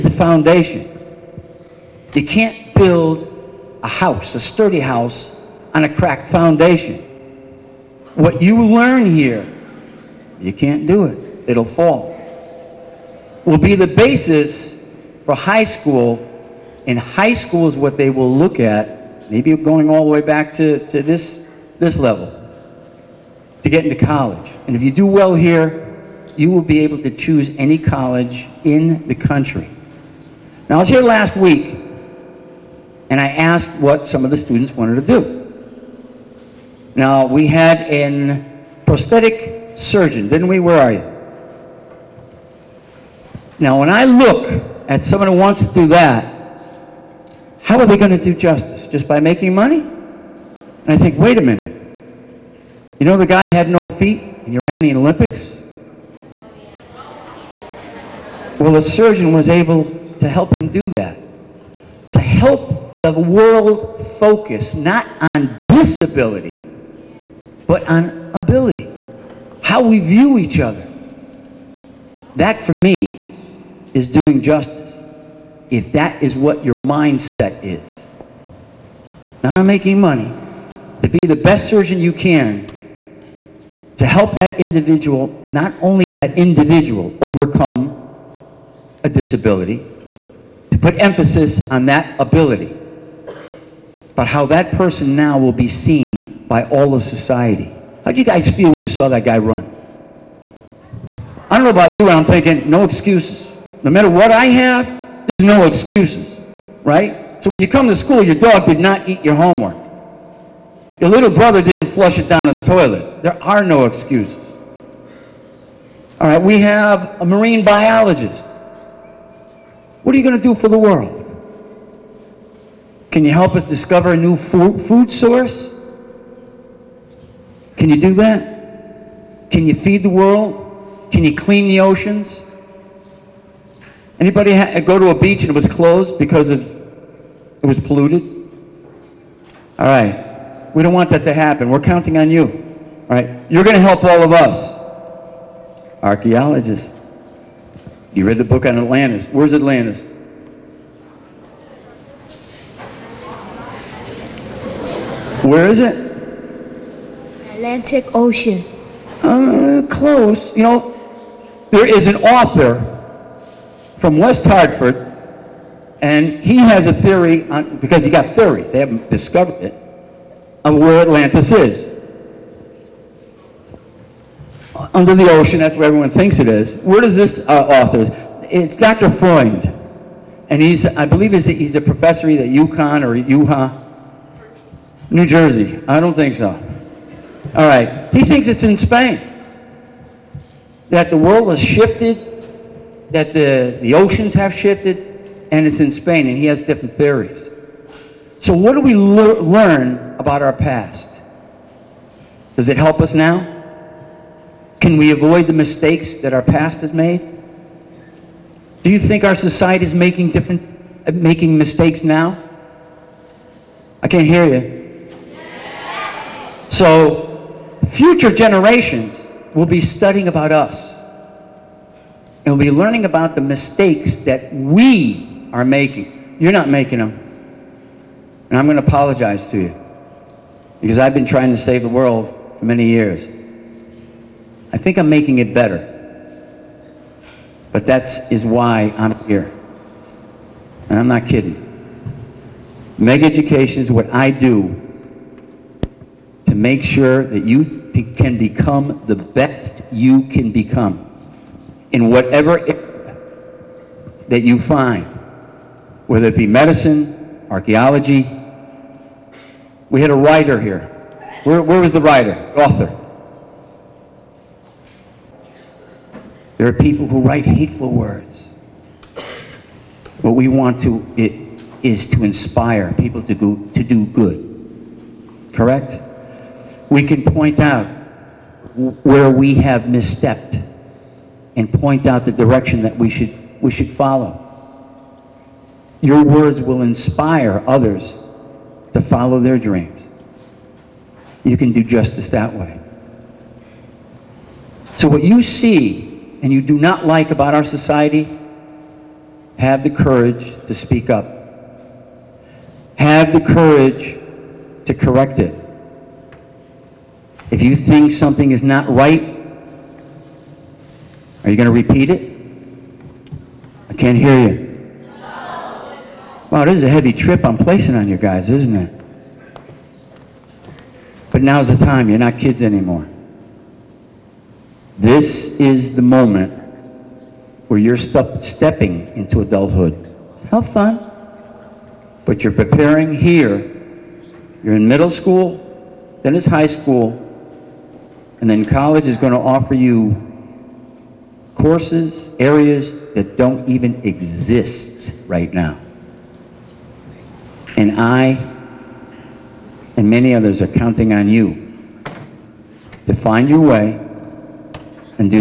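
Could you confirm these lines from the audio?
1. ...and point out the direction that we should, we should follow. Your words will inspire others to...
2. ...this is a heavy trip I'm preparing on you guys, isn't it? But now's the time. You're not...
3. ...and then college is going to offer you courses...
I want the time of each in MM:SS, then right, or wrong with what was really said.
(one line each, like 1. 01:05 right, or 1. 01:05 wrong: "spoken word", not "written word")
1. 04:41 right
2. 05:16 wrong: "placing", not "preparing"
3. 05:38 right.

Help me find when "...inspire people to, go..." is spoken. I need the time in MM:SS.
04:32.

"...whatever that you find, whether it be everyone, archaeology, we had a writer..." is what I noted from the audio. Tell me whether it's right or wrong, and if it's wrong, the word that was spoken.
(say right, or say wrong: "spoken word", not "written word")
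wrong: "medicine", not "everyone".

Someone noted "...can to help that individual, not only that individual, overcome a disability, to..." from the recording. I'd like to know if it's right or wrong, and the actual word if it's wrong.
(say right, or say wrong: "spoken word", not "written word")
right.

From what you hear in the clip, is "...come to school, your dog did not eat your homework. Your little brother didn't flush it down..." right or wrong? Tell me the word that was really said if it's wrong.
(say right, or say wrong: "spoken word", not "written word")
right.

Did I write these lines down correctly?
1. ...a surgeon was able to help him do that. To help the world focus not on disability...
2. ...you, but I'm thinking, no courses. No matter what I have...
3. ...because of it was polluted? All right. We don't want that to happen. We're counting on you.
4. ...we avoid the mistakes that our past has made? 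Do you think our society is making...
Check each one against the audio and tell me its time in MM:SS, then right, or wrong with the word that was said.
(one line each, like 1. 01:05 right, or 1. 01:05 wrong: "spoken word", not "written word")
1. 00:58 right
2. 01:41 wrong: "excuses", not "courses"
3. 02:16 right
4. 03:24 right.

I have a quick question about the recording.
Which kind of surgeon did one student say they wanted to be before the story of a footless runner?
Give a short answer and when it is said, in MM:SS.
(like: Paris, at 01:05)
prosthetic surgeon, at 00:38.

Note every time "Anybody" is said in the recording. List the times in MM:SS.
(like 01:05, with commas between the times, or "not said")
02:14.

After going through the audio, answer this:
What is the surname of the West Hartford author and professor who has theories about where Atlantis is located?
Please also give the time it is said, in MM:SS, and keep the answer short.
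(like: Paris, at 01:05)
Freund, at 02:59.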